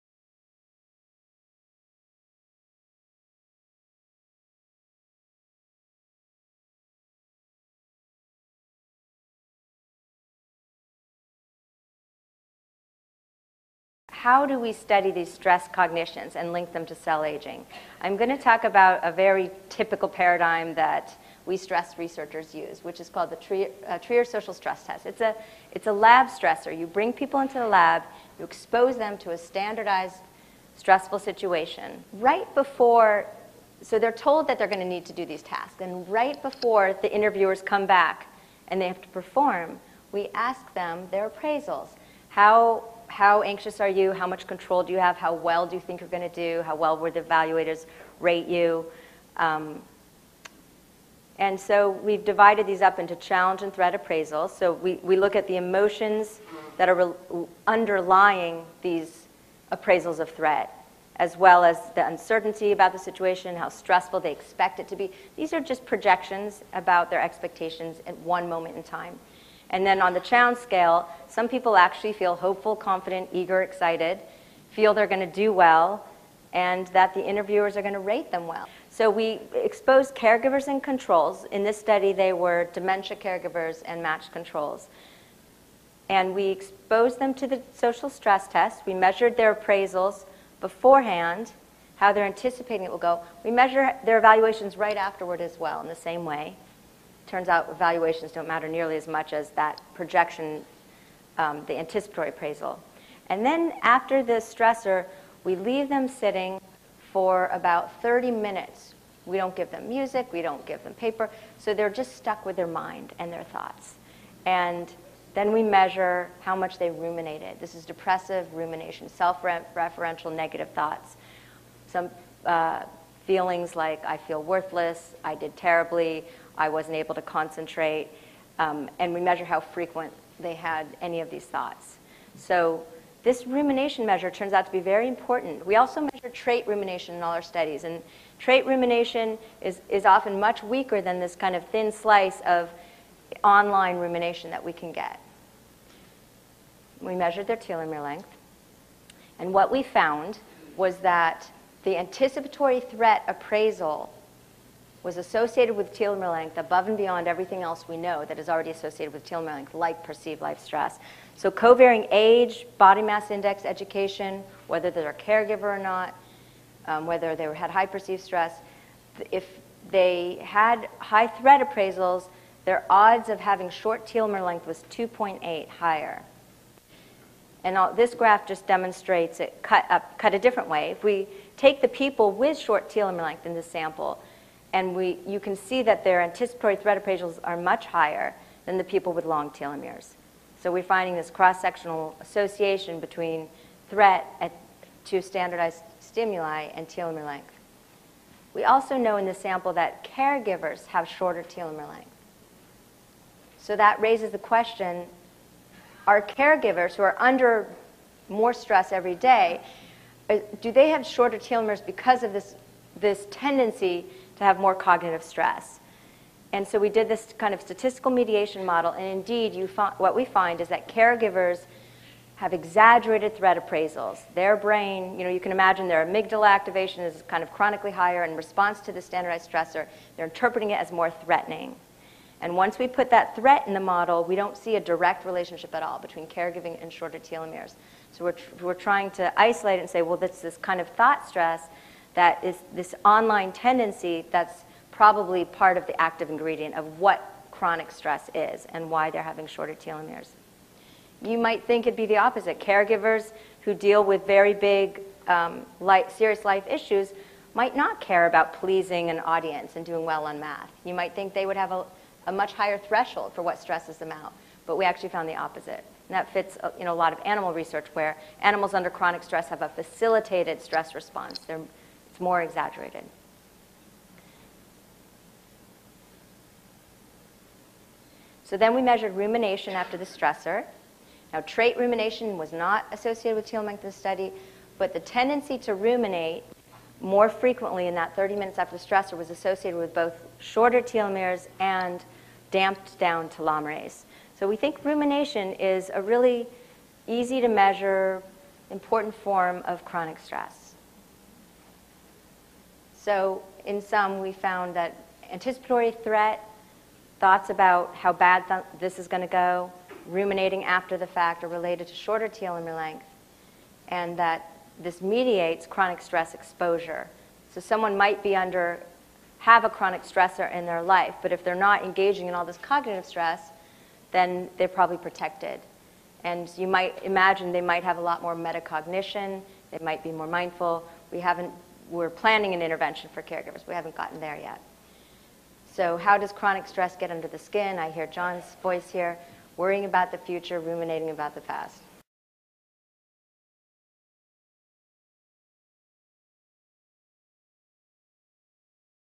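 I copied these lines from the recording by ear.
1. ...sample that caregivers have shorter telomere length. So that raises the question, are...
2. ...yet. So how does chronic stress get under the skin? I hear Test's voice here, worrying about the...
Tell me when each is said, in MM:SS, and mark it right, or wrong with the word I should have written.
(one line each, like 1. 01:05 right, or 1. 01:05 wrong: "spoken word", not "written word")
1. 03:19 right
2. 05:34 wrong: "John", not "Test".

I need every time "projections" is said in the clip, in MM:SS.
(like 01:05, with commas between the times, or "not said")
01:05, 01:39.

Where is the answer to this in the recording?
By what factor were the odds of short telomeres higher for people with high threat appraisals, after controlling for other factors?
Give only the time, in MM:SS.
02:54.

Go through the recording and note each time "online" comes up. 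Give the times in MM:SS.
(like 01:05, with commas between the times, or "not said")
02:23, 04:03.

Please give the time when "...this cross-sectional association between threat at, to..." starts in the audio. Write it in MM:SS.
03:11.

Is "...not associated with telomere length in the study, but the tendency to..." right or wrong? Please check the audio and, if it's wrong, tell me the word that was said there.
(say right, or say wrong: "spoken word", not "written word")
right.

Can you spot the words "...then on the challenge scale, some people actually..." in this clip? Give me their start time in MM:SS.
01:09.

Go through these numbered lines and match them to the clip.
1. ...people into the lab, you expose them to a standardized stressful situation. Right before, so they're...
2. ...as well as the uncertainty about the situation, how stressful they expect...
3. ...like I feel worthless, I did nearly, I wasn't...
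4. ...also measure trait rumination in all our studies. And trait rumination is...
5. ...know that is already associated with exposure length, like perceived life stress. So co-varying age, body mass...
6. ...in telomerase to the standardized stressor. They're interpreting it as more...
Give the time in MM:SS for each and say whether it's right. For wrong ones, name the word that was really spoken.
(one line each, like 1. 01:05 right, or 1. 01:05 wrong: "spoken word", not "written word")
1. 00:27 right
2. 01:01 right
3. 02:03 wrong: "terribly", not "nearly"
4. 02:15 right
5. 02:37 wrong: "telomere", not "exposure"
6. 03:48 wrong: "response", not "telomerase".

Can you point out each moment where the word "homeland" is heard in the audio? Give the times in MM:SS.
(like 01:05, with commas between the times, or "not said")
not said.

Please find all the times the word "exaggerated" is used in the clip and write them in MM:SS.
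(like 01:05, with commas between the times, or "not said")
03:42, 04:32.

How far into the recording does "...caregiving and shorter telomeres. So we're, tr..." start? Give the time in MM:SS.
03:56.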